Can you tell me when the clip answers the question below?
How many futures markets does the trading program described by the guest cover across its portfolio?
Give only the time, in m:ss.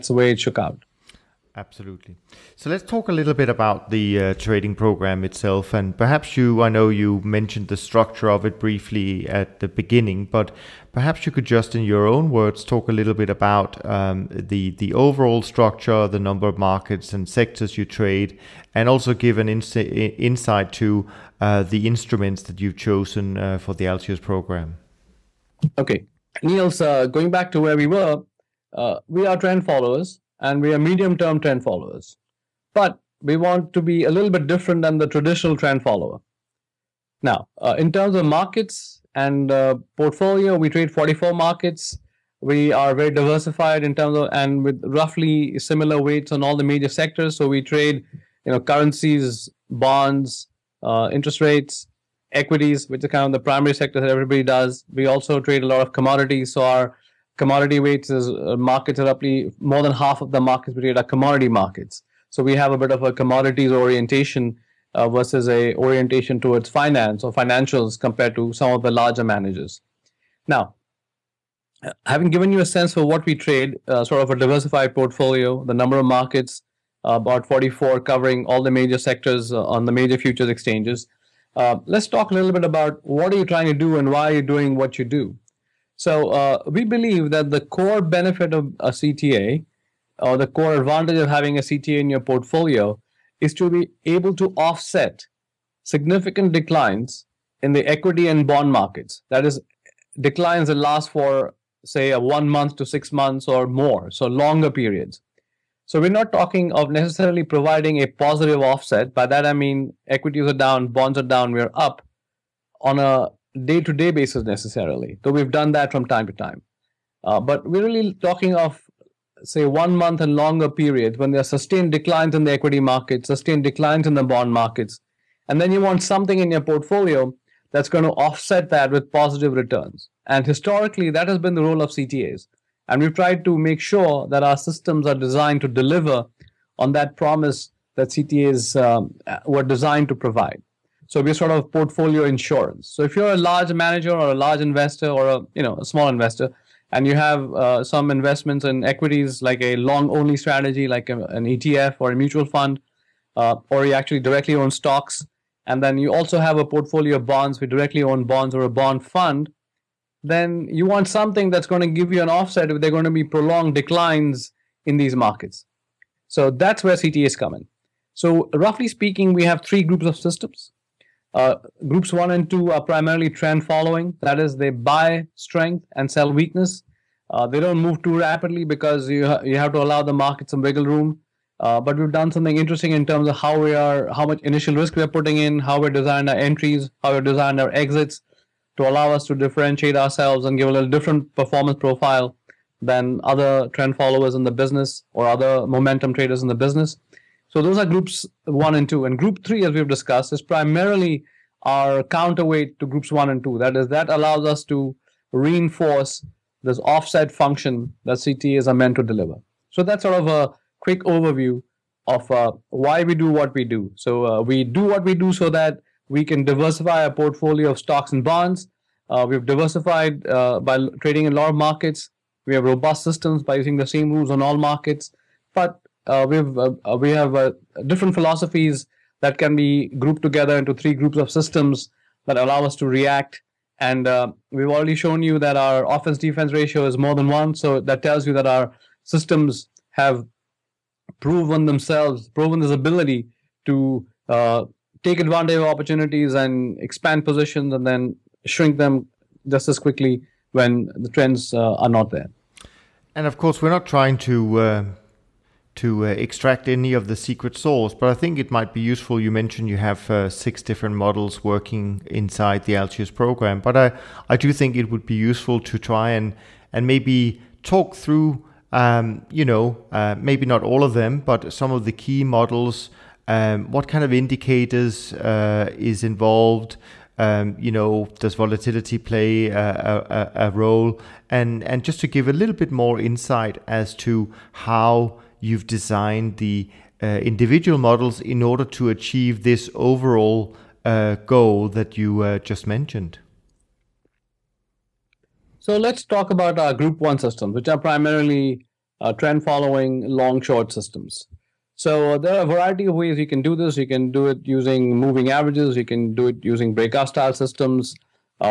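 0:40.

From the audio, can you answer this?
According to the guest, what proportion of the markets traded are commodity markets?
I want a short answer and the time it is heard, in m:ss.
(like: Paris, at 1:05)
more than half, at 0:59.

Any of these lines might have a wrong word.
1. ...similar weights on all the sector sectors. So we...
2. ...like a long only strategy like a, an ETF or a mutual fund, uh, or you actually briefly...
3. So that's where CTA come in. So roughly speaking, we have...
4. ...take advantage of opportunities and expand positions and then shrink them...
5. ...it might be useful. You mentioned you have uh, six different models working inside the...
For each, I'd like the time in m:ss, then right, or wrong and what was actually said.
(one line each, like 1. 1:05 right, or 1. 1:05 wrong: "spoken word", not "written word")
1. 0:45 wrong: "major", not "sector"
2. 2:29 wrong: "directly", not "briefly"
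3. 2:46 right
4. 4:05 right
5. 4:18 right.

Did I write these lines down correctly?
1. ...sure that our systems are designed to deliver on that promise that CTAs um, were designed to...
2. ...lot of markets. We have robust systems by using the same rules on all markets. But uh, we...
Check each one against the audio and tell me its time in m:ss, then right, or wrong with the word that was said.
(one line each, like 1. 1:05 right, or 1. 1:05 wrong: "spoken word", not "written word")
1. 2:13 right
2. 3:41 right.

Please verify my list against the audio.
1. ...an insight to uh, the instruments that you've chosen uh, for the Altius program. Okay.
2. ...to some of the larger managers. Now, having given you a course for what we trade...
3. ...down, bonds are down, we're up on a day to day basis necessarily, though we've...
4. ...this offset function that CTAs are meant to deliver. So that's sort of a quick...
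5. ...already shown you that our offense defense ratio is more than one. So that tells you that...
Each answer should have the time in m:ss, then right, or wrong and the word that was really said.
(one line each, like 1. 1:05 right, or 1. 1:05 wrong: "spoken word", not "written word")
1. 0:19 right
2. 1:08 wrong: "sense", not "course"
3. 1:50 right
4. 3:26 right
5. 3:54 right.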